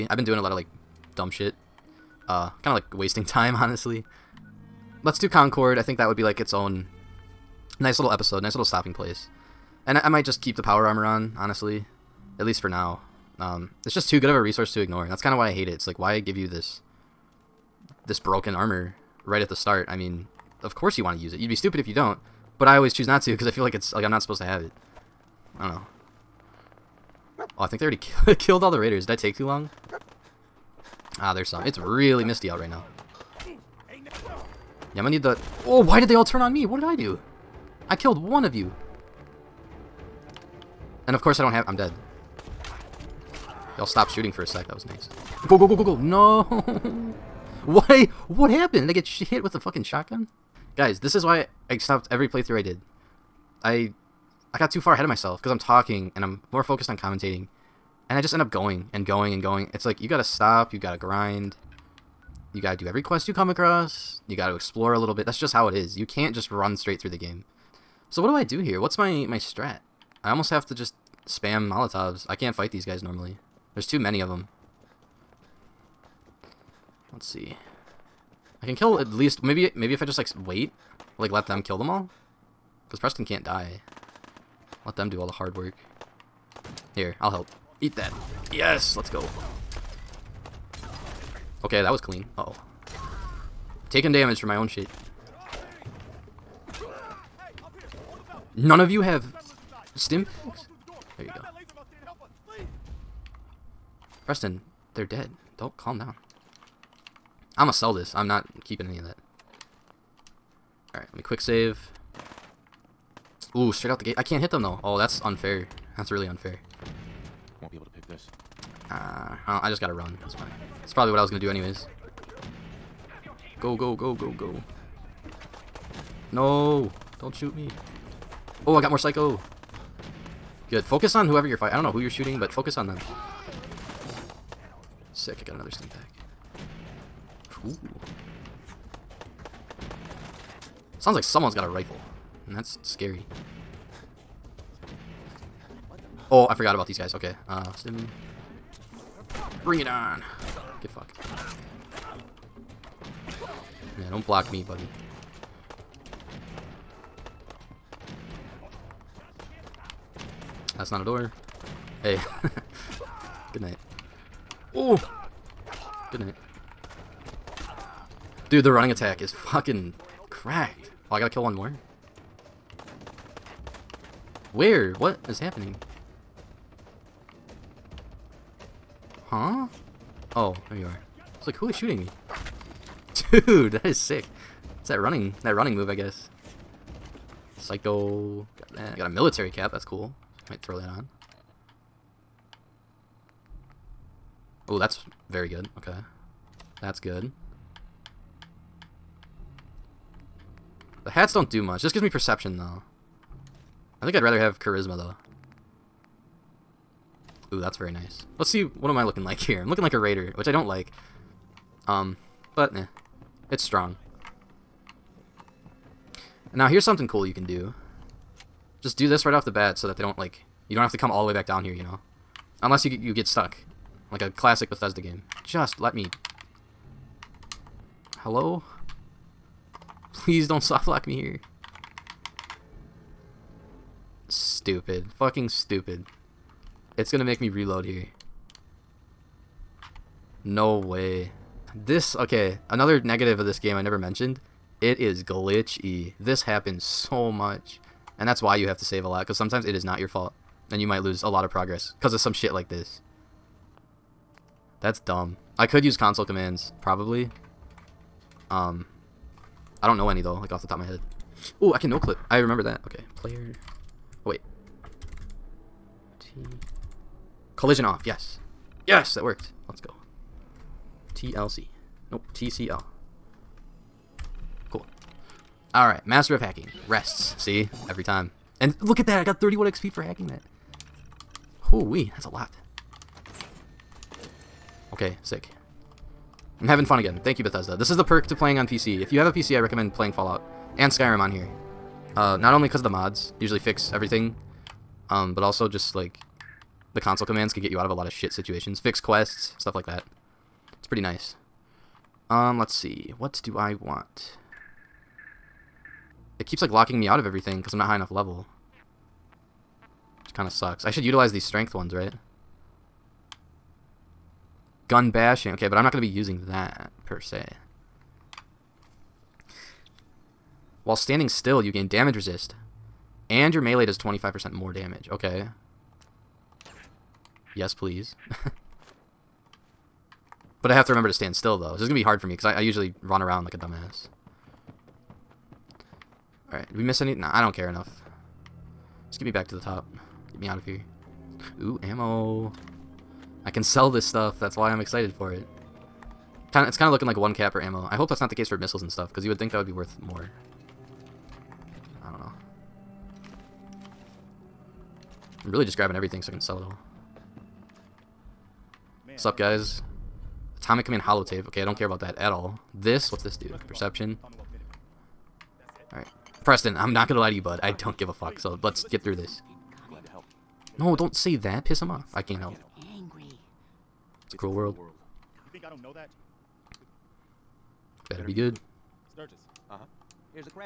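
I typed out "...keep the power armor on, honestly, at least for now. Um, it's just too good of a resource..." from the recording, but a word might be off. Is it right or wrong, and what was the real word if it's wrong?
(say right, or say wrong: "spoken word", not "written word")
right.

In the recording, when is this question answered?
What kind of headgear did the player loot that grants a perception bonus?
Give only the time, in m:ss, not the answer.
3:09.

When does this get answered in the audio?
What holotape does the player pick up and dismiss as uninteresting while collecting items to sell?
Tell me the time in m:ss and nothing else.
6:00.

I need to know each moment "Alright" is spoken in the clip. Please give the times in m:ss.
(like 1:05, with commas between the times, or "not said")
1:50, 5:36, 6:05.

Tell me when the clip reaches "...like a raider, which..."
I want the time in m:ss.
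3:29.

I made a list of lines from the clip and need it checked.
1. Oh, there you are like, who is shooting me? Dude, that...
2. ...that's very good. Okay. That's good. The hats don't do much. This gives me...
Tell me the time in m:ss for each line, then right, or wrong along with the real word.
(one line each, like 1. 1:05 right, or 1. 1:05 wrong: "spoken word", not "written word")
1. 3:00 right
2. 3:14 right.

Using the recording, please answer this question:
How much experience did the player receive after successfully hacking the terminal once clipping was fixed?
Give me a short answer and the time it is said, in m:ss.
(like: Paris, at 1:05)
31 XP, at 4:39.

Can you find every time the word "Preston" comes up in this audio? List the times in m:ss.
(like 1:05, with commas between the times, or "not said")
1:22, 1:44, 6:06.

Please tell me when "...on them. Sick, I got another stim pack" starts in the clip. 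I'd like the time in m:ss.
2:12.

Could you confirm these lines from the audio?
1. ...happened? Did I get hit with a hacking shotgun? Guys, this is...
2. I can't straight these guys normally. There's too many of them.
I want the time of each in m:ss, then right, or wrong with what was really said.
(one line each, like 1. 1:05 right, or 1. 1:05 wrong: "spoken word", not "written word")
1. 0:48 wrong: "fucking", not "hacking"
2. 1:12 wrong: "fight", not "straight".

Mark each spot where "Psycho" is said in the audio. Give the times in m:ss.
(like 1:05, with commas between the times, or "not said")
2:08, 3:07.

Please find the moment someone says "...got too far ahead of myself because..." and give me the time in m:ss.
0:54.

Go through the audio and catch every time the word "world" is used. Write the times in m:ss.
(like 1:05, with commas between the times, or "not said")
6:14.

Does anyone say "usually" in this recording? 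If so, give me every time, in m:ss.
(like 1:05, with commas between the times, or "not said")
4:53, 5:32.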